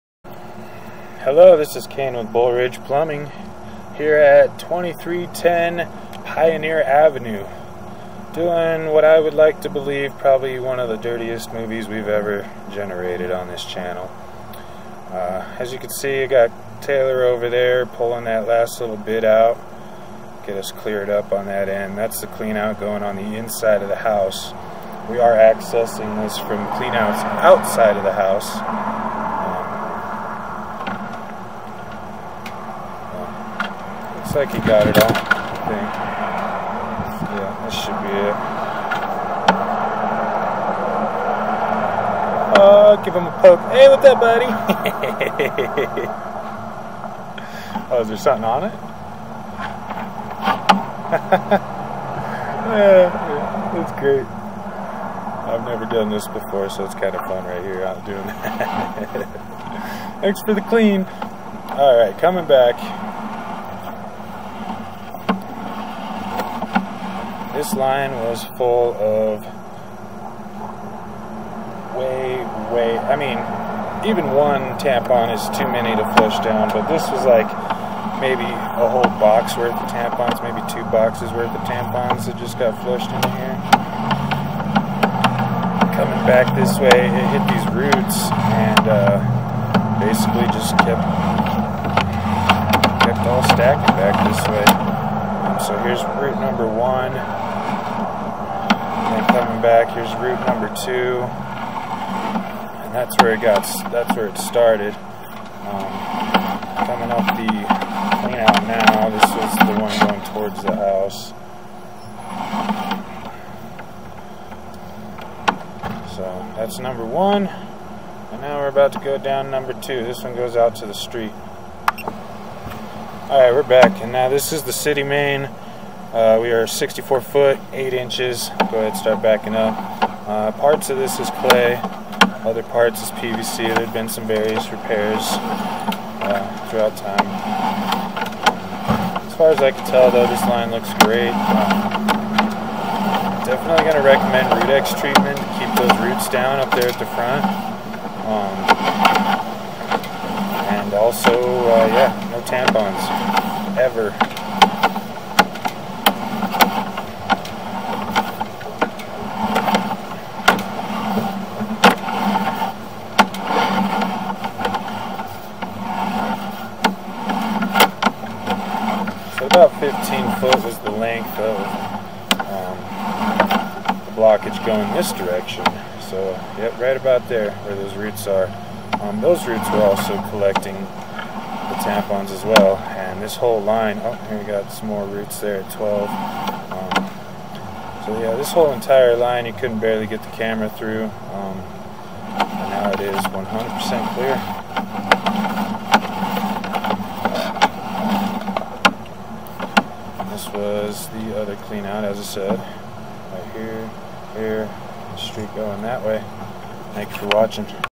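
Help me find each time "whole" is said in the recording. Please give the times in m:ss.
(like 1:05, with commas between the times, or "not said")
1:18, 3:03, 3:08.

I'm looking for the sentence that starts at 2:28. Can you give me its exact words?
Um, and also, uh, yeah, no tampons, ever.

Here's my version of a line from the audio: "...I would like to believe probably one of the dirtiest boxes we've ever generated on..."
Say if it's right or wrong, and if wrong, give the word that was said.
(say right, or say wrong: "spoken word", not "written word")
wrong: "movies", not "boxes".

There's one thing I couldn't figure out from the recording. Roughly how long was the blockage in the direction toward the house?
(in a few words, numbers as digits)
15 feet.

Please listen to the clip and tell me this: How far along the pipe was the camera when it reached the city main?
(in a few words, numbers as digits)
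64 feet 8 inches.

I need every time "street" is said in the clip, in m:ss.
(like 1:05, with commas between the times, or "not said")
2:00, 3:25.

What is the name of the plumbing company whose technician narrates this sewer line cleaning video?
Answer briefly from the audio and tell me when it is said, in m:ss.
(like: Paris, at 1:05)
Bull Ridge Plumbing, at 0:02.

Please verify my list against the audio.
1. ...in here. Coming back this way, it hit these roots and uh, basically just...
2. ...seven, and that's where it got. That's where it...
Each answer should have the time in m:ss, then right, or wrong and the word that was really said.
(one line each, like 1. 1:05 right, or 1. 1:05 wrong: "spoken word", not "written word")
1. 1:23 right
2. 1:40 wrong: "two", not "seven".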